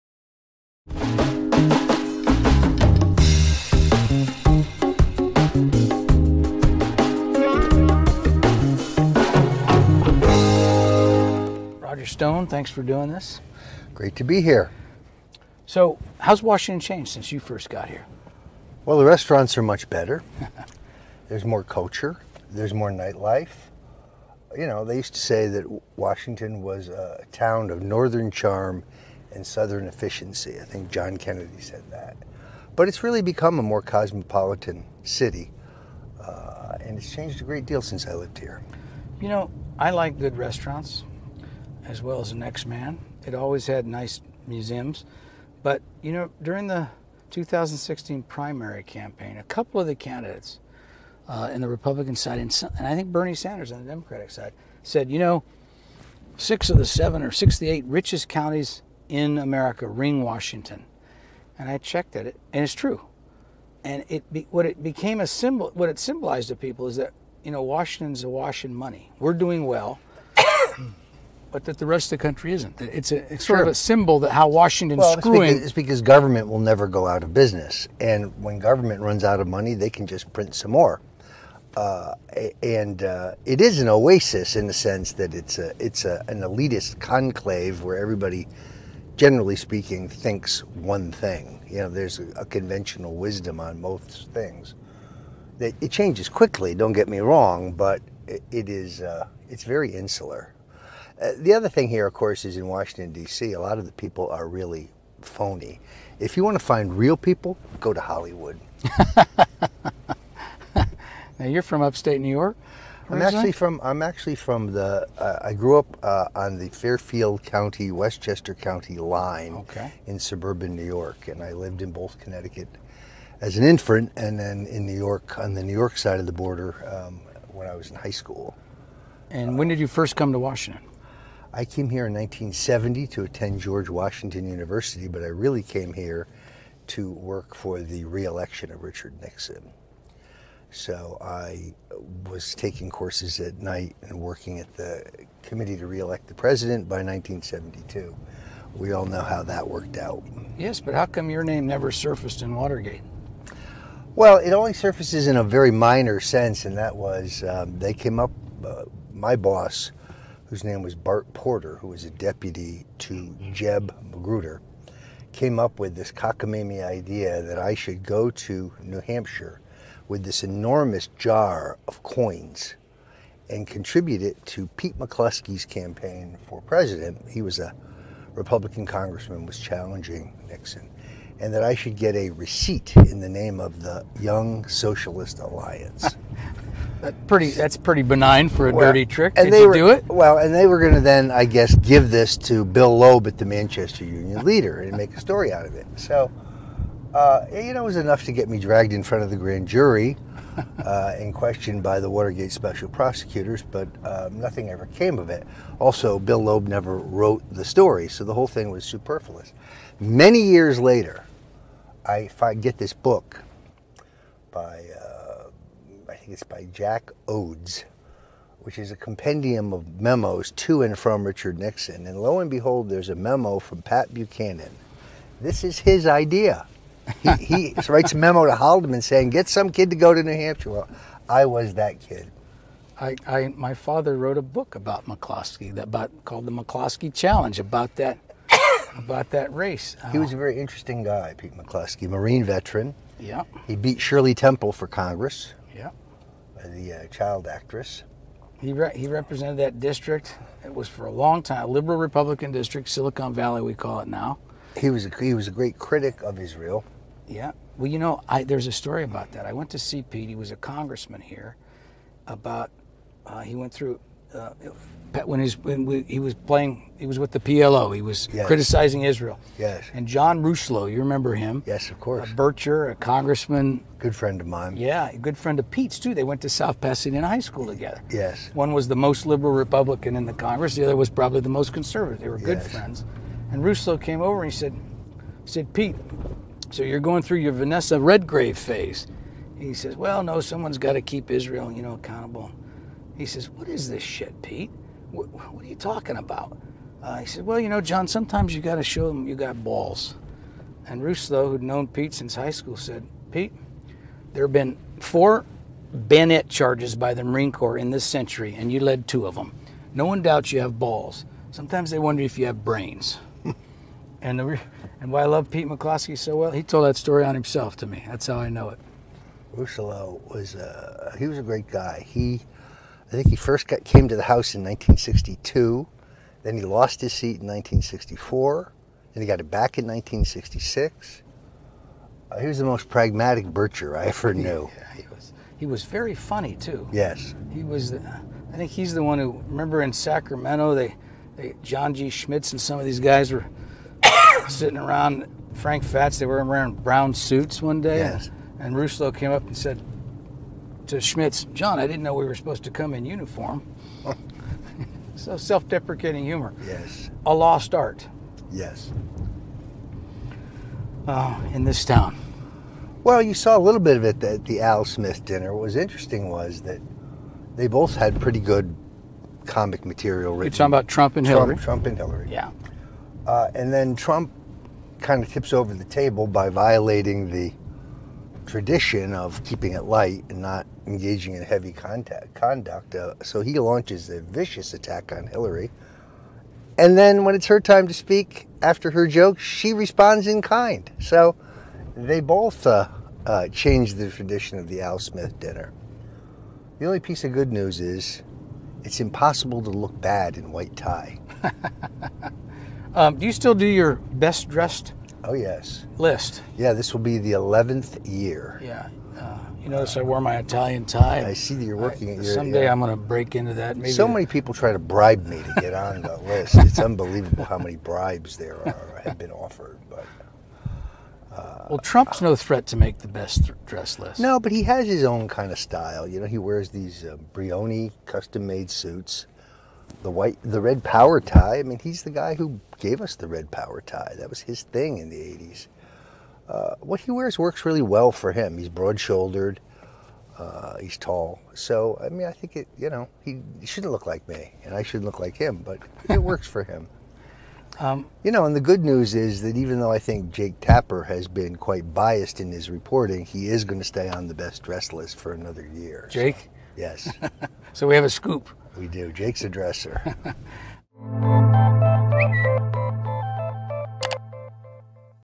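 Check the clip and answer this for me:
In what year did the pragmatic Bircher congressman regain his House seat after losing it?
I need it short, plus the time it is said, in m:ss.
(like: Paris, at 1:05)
1966, at 5:29.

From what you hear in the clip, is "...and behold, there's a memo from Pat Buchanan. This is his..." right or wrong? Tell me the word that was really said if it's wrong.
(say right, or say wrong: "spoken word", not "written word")
right.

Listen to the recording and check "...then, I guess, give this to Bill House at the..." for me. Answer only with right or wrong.
wrong.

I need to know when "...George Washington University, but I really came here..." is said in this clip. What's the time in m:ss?
2:13.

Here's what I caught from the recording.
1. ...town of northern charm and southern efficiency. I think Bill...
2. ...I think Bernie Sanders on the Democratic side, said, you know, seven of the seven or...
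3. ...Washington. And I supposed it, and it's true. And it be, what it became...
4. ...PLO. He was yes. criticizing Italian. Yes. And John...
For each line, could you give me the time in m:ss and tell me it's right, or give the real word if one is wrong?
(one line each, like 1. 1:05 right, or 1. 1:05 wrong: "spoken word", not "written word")
1. 0:27 wrong: "John", not "Bill"
2. 0:52 wrong: "six", not "seven"
3. 1:00 wrong: "checked", not "supposed"
4. 4:27 wrong: "Israel", not "Italian".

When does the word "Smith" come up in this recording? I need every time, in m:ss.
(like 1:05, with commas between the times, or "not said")
6:04, 6:34.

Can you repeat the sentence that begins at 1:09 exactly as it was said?
We're doing well but that the rest of the country isn't.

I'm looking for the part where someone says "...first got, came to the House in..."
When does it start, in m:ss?
5:23.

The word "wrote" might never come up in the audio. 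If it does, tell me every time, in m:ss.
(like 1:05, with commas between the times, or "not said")
3:26, 3:54.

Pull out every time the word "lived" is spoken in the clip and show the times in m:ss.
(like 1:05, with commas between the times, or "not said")
0:38, 2:01.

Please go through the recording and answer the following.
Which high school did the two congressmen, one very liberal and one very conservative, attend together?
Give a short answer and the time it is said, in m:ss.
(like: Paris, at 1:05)
South Pasadena High School, at 4:36.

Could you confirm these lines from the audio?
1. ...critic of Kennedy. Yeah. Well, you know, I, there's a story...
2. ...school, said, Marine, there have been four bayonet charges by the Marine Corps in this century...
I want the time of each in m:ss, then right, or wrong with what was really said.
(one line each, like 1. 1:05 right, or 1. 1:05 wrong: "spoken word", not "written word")
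1. 4:15 wrong: "Israel", not "Kennedy"
2. 5:02 wrong: "Pete", not "Marine".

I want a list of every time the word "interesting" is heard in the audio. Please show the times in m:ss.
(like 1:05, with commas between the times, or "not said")
4:00, 6:05.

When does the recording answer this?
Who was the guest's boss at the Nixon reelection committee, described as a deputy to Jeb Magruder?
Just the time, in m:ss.
2:40.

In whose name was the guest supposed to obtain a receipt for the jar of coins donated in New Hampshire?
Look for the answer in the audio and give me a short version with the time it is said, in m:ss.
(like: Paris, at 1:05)
Young Socialist Alliance, at 3:04.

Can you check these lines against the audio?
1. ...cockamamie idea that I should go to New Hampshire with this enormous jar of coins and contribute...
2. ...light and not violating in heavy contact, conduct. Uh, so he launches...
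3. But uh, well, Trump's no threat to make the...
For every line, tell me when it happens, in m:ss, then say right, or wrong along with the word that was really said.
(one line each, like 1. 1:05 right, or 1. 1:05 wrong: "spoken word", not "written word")
1. 2:46 right
2. 6:19 wrong: "engaging", not "violating"
3. 6:59 right.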